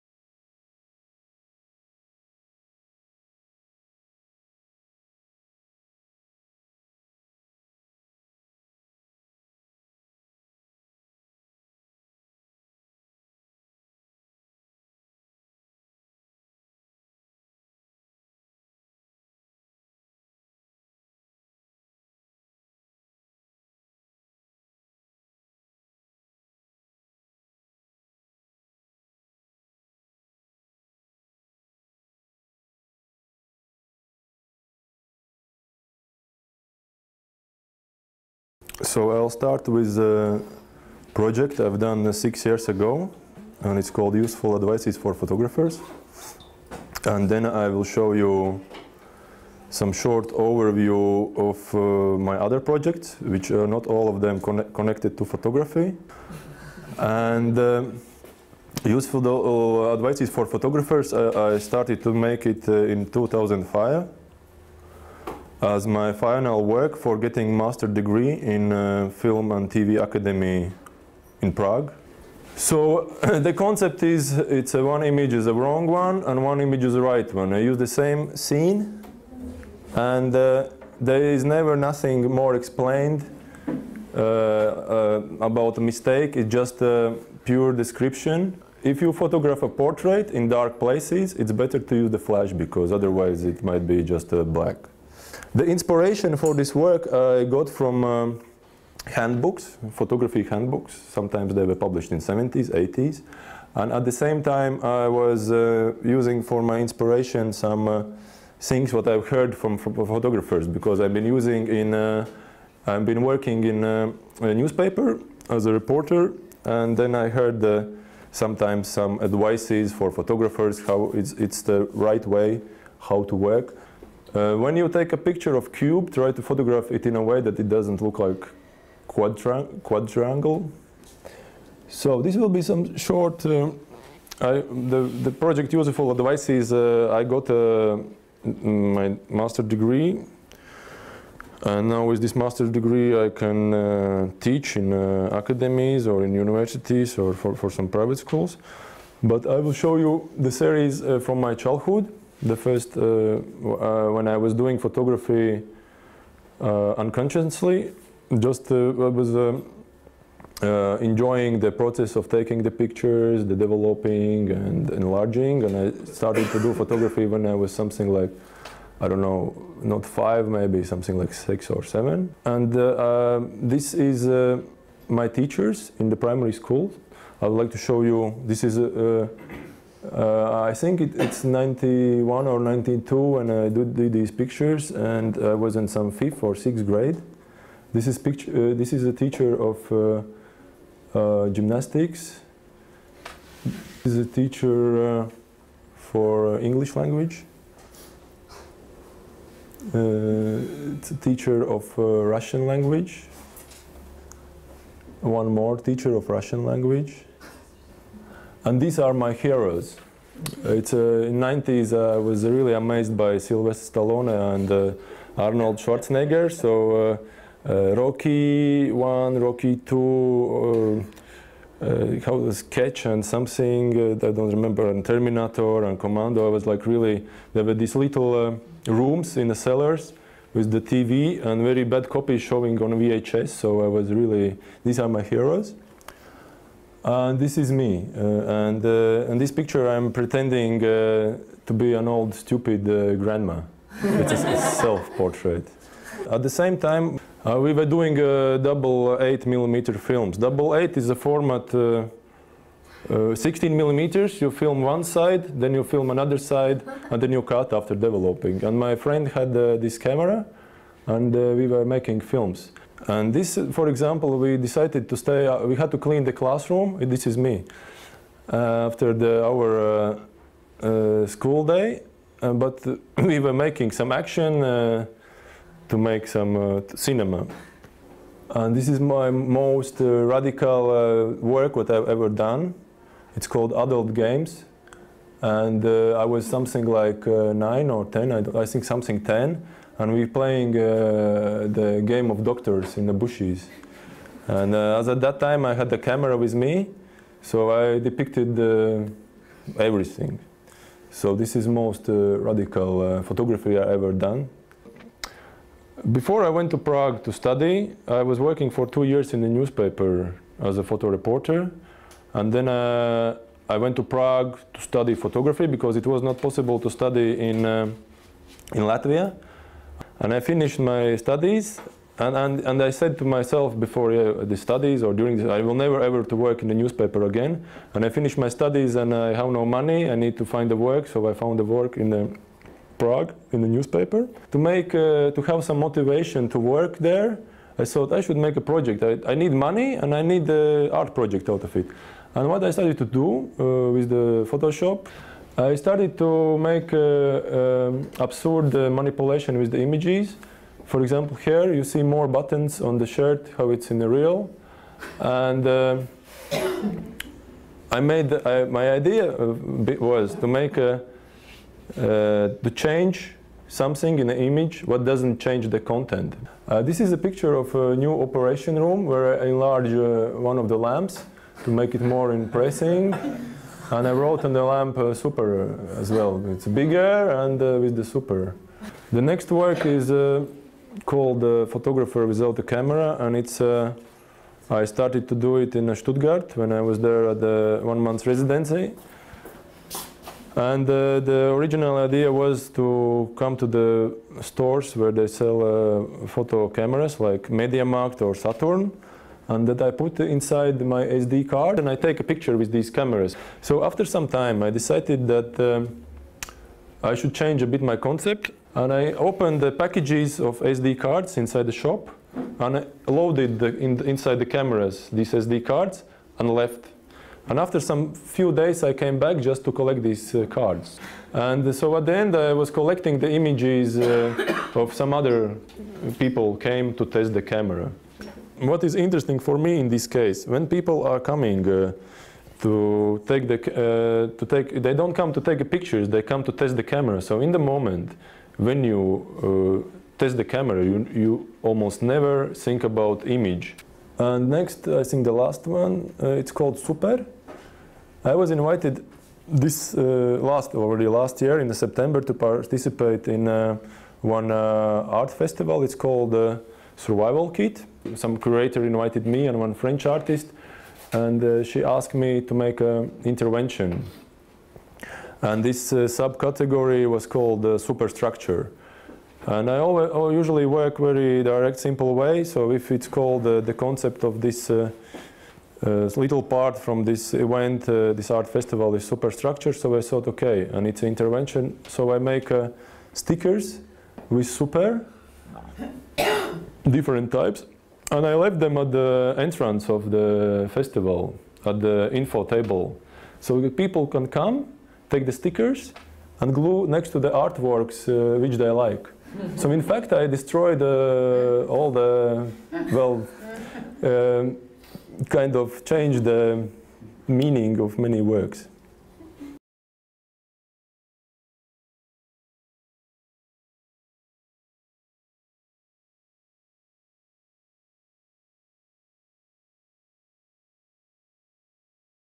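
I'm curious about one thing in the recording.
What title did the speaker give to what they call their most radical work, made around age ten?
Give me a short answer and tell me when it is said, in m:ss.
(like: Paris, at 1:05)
Adult Games, at 4:43.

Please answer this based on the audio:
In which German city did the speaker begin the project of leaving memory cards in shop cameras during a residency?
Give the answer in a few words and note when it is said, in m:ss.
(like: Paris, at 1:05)
Stuttgart, at 6:25.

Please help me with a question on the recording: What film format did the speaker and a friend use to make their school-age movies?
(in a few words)
Double eight millimeter.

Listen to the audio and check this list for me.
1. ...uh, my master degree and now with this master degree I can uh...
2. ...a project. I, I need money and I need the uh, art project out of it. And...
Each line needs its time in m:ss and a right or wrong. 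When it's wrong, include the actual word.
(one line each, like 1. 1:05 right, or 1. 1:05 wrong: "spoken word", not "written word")
1. 2:17 right
2. 5:38 right.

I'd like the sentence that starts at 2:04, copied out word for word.
Uh, when you take a picture of cube, try to photograph it in a way that it doesn't look like quadra quadrangle.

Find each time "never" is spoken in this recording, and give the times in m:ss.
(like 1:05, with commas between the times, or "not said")
1:21, 5:25, 7:22.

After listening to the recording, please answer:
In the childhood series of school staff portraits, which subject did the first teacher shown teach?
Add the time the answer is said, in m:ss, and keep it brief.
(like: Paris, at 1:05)
Gymnastics, at 3:11.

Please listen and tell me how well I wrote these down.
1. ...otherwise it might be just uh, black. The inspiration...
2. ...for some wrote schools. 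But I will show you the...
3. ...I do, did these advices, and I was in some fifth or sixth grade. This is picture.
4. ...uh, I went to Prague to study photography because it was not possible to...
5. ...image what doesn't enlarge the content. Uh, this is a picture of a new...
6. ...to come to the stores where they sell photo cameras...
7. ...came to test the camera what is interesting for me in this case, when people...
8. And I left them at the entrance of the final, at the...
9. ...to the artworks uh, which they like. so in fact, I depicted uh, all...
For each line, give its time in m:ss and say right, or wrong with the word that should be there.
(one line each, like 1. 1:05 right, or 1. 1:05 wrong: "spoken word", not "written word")
1. 1:32 right
2. 2:27 wrong: "private", not "wrote"
3. 3:03 wrong: "pictures", not "advices"
4. 5:12 right
5. 6:04 wrong: "change", not "enlarge"
6. 6:32 right
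7. 7:06 right
8. 8:08 wrong: "festival", not "final"
9. 8:17 wrong: "destroyed", not "depicted".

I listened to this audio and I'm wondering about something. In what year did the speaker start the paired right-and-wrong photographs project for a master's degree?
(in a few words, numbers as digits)
2005.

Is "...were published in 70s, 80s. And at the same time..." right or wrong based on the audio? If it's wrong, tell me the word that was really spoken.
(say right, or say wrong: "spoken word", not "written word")
right.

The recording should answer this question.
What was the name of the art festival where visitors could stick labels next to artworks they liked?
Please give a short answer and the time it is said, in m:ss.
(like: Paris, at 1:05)
Survival Kit, at 7:37.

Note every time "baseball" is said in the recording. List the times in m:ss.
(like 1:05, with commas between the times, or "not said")
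not said.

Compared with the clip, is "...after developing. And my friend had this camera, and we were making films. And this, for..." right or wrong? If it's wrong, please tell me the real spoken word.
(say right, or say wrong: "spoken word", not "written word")
right.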